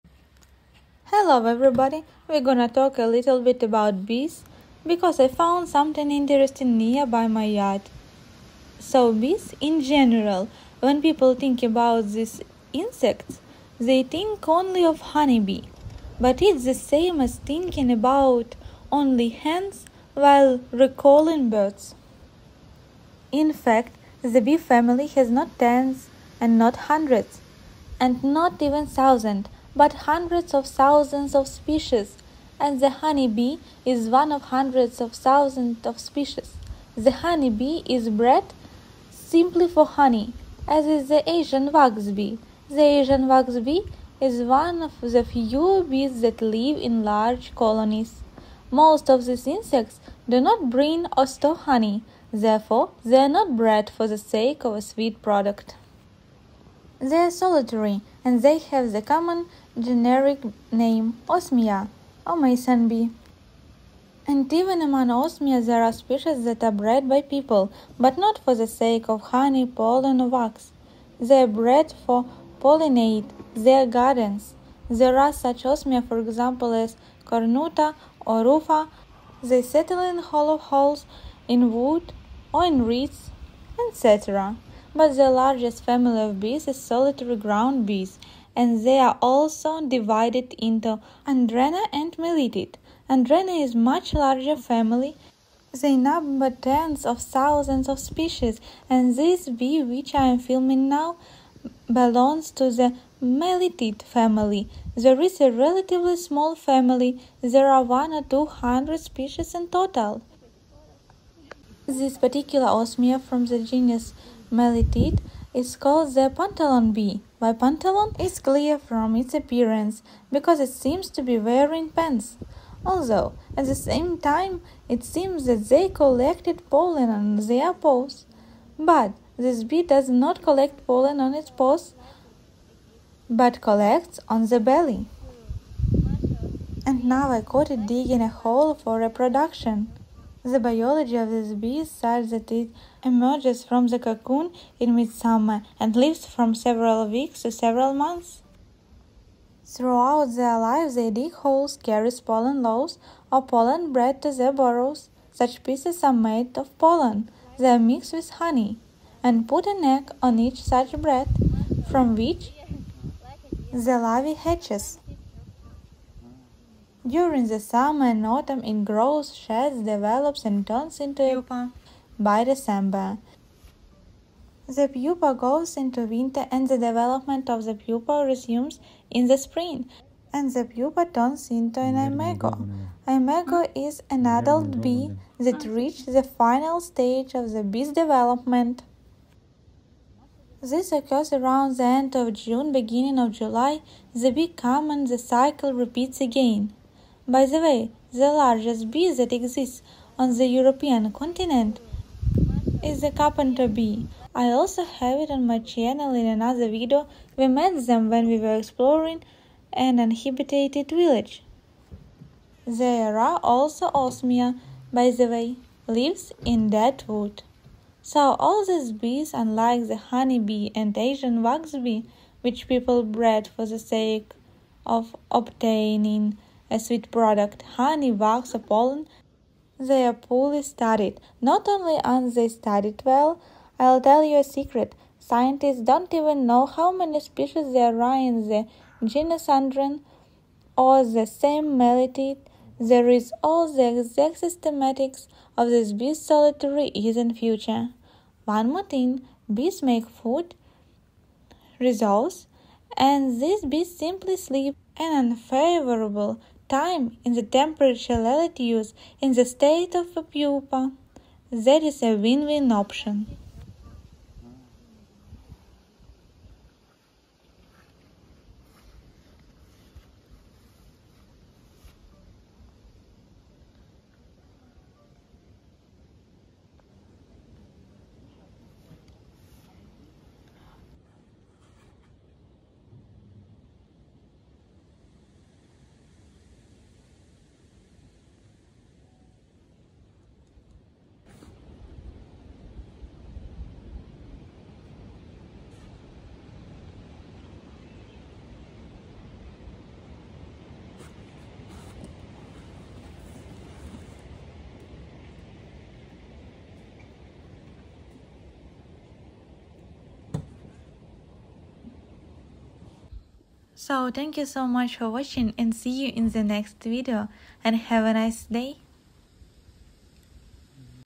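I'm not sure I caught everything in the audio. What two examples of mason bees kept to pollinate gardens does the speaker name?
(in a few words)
Cornuta or Rufa.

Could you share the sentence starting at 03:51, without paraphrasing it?
Not only aren't they studied well, I'll tell you a secret.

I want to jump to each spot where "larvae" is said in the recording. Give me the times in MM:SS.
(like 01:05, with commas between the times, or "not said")
02:43.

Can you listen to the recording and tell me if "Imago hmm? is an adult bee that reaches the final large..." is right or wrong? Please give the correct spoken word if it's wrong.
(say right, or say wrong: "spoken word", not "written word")
wrong: "stage", not "large".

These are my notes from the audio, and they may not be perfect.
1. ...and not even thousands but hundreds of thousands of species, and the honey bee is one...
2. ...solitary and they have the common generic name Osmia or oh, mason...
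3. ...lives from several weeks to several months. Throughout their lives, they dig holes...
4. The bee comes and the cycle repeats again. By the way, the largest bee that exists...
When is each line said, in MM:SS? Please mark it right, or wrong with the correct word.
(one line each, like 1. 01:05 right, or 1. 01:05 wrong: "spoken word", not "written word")
1. 00:27 right
2. 00:57 right
3. 02:25 right
4. 03:14 right.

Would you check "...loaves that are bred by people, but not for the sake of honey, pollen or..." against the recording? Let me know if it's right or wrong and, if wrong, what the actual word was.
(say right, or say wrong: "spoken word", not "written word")
wrong: "species", not "loaves".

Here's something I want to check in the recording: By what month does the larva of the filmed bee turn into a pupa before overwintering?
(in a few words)
December.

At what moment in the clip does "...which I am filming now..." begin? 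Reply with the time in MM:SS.
01:39.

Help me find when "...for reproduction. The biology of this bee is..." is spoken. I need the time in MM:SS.
02:18.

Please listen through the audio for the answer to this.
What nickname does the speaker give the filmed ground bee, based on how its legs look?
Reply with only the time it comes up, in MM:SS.
01:56.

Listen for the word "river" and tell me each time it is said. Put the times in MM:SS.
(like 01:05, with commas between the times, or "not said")
not said.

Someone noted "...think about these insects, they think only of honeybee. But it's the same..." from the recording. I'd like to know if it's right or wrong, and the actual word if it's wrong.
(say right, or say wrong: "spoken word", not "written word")
right.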